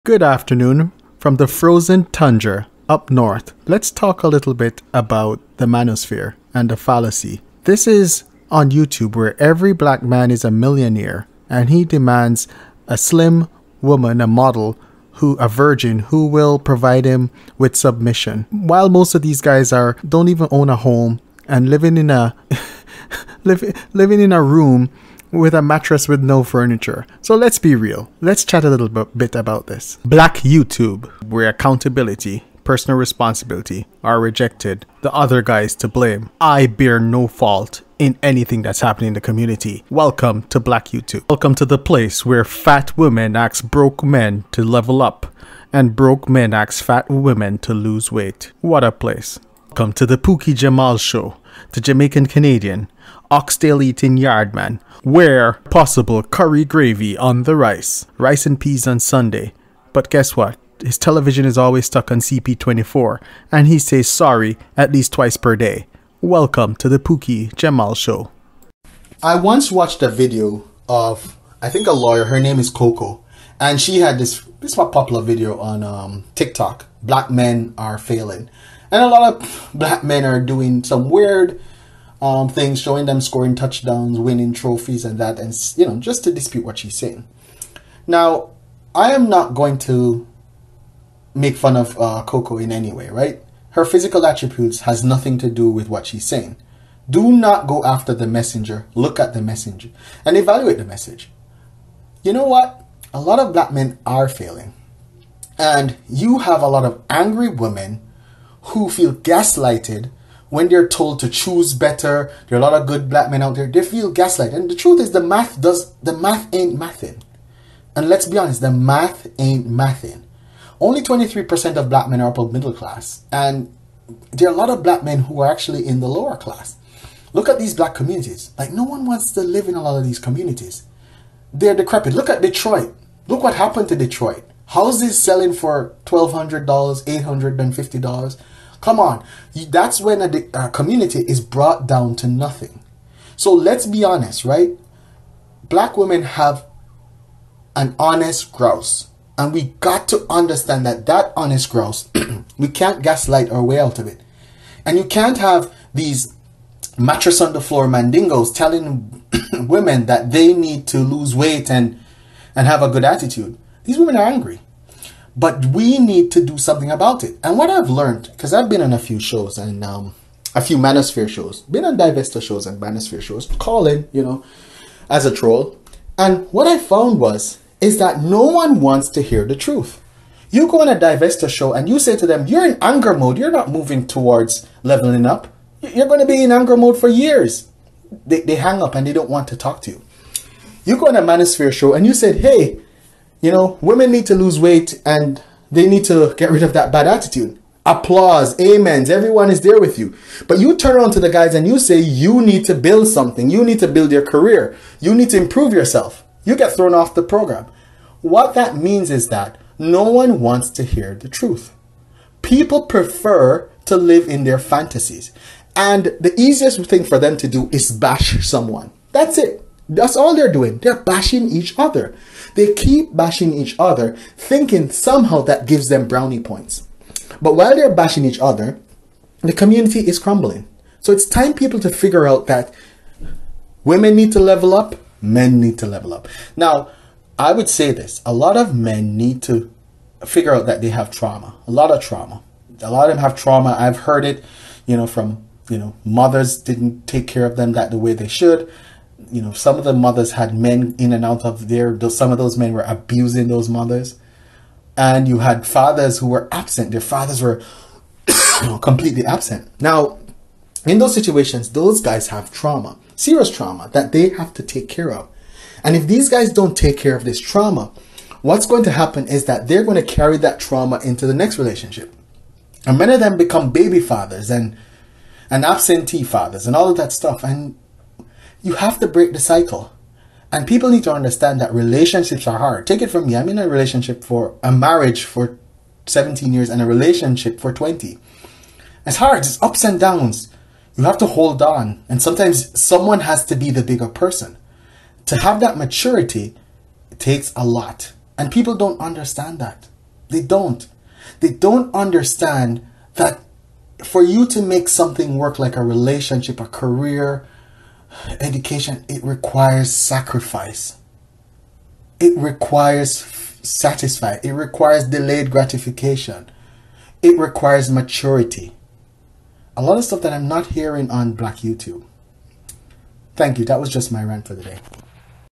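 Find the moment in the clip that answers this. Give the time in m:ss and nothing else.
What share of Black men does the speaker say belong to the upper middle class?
2:01.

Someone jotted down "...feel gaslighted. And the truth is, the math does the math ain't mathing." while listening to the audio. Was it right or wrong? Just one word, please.
right.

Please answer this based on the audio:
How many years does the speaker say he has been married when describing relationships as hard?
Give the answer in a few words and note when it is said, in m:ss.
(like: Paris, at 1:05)
17, at 4:46.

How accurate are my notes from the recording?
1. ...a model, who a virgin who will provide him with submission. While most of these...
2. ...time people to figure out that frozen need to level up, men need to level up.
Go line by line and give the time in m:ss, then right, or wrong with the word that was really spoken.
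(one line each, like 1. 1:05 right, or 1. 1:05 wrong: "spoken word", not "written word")
1. 0:14 right
2. 3:51 wrong: "women", not "frozen".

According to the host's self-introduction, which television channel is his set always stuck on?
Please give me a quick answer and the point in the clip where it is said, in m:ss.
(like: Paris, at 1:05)
CP24, at 1:02.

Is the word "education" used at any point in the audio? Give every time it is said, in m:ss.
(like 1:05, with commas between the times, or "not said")
5:08.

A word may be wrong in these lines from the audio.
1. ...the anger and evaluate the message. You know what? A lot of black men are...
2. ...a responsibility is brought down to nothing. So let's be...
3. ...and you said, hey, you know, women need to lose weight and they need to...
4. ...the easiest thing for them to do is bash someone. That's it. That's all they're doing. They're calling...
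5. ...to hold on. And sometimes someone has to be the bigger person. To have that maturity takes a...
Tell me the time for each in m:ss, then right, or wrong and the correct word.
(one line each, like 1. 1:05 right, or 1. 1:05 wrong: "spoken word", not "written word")
1. 1:39 wrong: "messenger", not "anger"
2. 2:20 wrong: "community", not "responsibility"
3. 3:11 right
4. 3:36 wrong: "bashing", not "calling"
5. 4:51 right.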